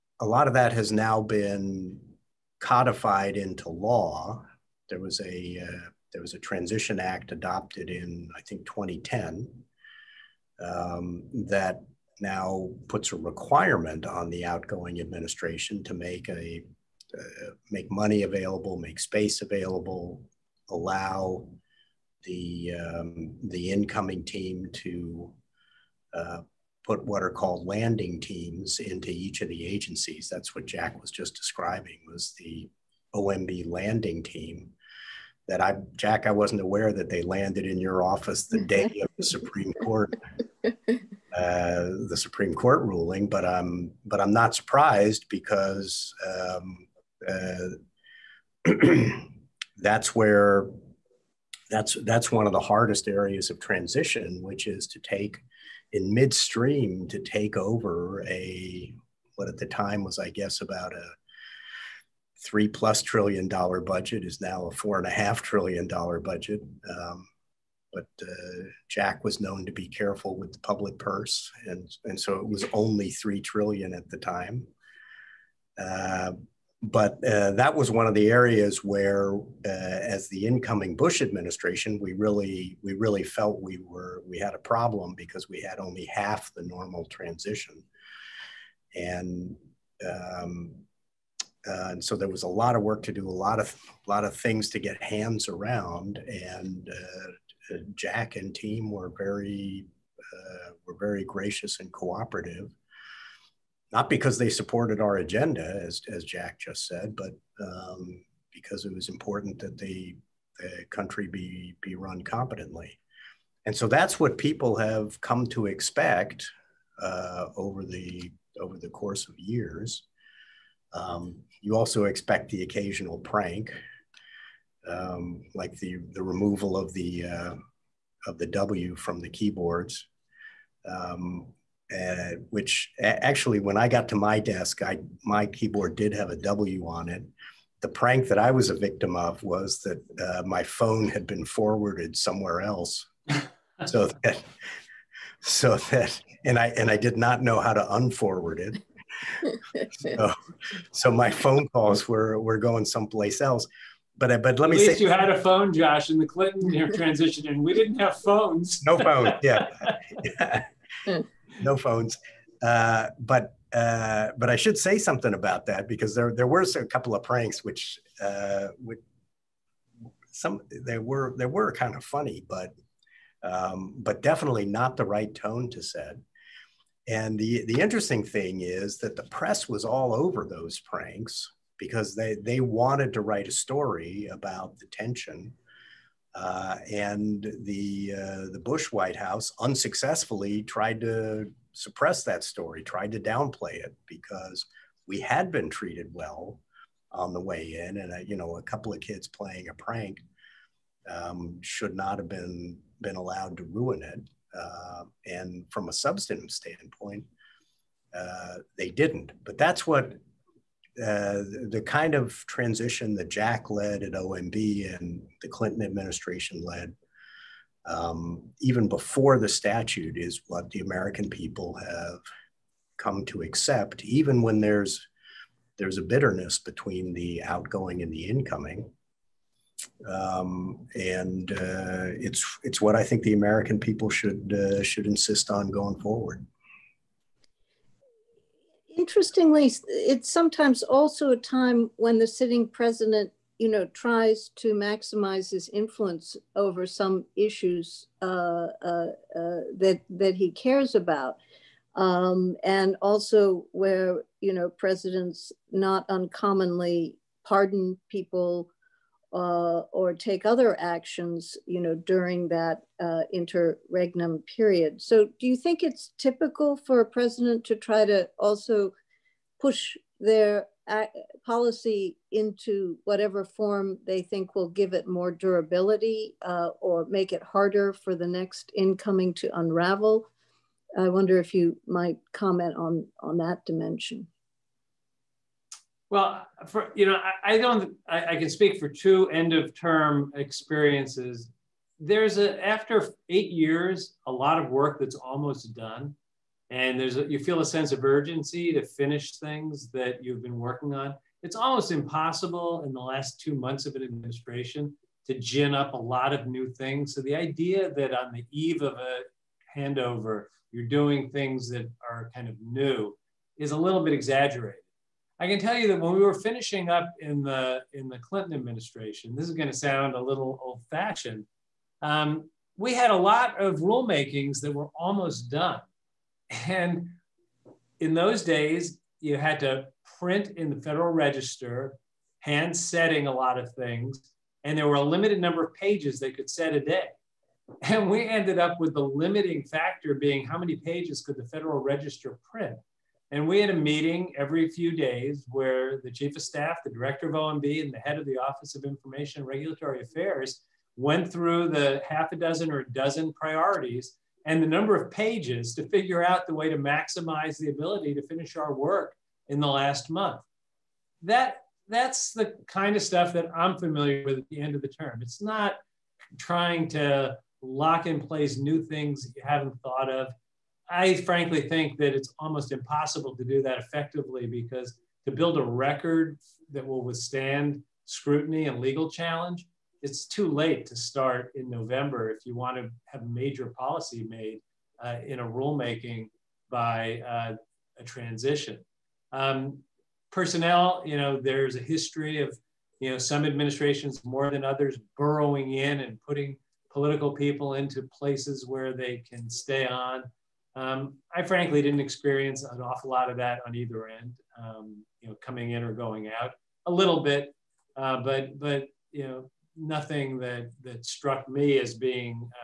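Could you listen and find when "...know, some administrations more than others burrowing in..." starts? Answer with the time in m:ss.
6:33.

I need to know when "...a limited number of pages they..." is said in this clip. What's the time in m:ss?
5:34.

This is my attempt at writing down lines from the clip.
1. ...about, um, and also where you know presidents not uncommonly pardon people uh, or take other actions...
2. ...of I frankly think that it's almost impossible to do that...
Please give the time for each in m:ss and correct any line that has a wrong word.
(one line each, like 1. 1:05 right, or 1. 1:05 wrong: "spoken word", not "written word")
1. 4:10 right
2. 6:10 right.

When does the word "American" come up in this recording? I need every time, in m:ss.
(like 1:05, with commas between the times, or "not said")
3:40, 3:53.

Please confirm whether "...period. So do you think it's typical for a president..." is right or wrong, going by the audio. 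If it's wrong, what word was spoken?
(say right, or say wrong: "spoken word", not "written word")
right.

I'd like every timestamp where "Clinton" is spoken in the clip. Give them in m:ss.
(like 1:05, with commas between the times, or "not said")
2:36, 3:35, 5:18.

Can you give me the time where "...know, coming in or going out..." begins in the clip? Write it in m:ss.
6:45.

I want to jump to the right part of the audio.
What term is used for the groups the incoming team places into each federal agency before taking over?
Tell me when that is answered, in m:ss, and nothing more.
0:27.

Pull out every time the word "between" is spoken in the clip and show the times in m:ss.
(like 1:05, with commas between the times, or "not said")
3:46.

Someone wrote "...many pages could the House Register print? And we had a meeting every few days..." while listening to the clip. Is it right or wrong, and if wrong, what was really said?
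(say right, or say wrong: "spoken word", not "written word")
wrong: "Federal", not "House".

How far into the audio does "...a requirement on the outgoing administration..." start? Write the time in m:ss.
0:13.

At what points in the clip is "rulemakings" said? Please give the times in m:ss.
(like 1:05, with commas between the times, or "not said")
5:23, 6:25.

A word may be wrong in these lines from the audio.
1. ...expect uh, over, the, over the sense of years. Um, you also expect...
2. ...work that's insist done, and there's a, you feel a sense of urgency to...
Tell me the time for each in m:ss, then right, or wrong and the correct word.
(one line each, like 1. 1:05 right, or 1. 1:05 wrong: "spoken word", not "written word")
1. 1:55 wrong: "course", not "sense"
2. 4:54 wrong: "almost", not "insist".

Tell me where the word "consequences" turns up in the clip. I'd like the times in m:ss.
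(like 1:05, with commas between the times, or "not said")
not said.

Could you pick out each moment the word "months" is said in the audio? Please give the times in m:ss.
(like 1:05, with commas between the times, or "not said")
5:03, 6:00.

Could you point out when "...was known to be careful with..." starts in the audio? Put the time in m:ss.
1:09.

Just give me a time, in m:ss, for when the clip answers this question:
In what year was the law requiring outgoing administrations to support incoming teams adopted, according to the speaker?
0:08.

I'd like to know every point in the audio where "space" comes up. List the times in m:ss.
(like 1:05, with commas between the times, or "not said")
0:18.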